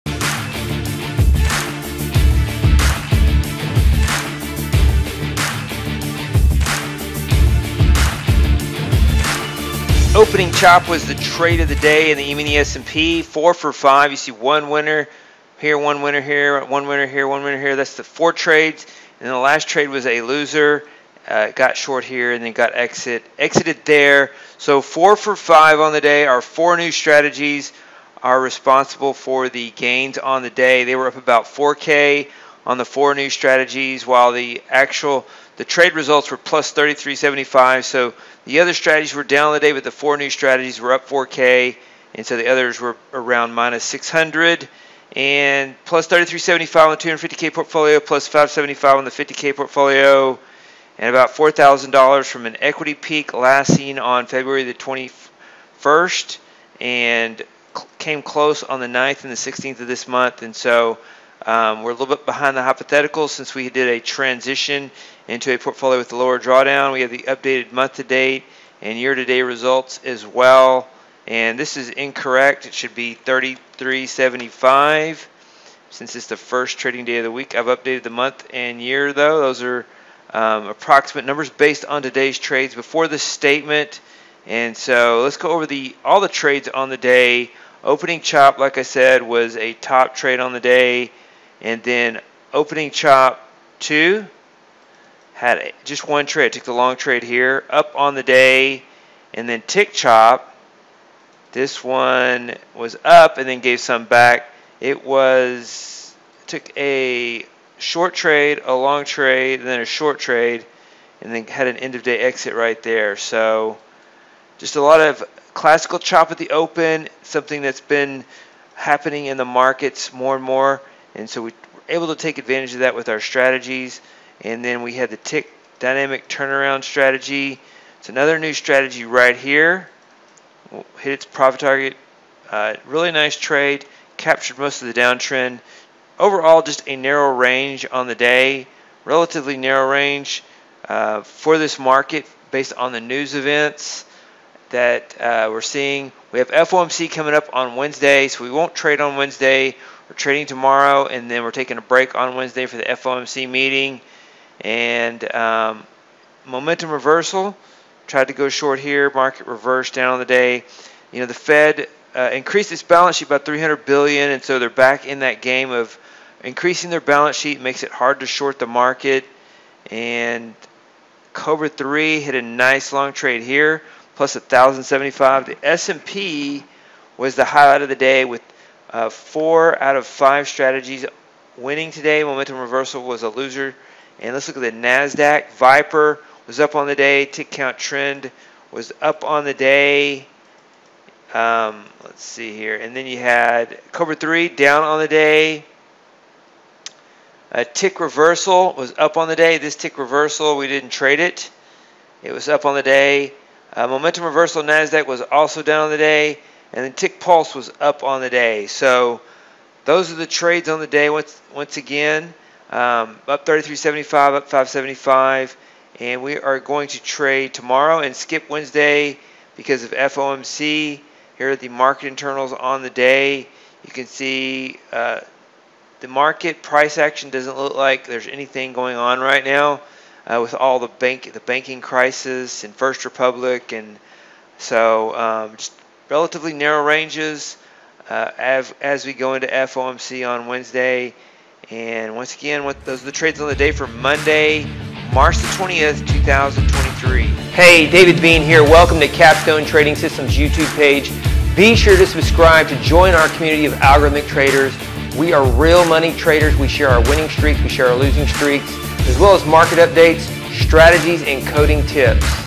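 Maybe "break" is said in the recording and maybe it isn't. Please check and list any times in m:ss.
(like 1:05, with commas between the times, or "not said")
2:31.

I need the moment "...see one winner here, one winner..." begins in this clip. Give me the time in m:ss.
0:14.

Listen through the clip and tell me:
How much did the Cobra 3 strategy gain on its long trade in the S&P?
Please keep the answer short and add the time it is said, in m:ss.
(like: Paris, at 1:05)
$1,075, at 2:54.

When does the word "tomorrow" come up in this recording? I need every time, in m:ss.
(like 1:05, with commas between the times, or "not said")
2:30, 3:37.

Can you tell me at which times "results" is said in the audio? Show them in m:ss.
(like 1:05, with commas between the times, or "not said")
0:35, 1:09.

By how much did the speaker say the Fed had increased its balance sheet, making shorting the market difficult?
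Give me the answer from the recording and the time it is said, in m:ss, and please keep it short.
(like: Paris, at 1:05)
300 billion, at 2:43.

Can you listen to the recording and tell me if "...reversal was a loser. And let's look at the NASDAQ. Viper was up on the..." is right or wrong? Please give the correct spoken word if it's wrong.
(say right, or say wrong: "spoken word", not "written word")
right.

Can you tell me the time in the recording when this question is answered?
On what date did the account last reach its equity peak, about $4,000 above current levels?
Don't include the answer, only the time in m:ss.
0:54.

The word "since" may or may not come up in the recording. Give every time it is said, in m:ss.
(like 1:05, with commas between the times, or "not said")
1:03, 1:15.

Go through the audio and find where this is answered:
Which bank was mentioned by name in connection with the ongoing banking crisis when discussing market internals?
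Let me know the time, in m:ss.
3:52.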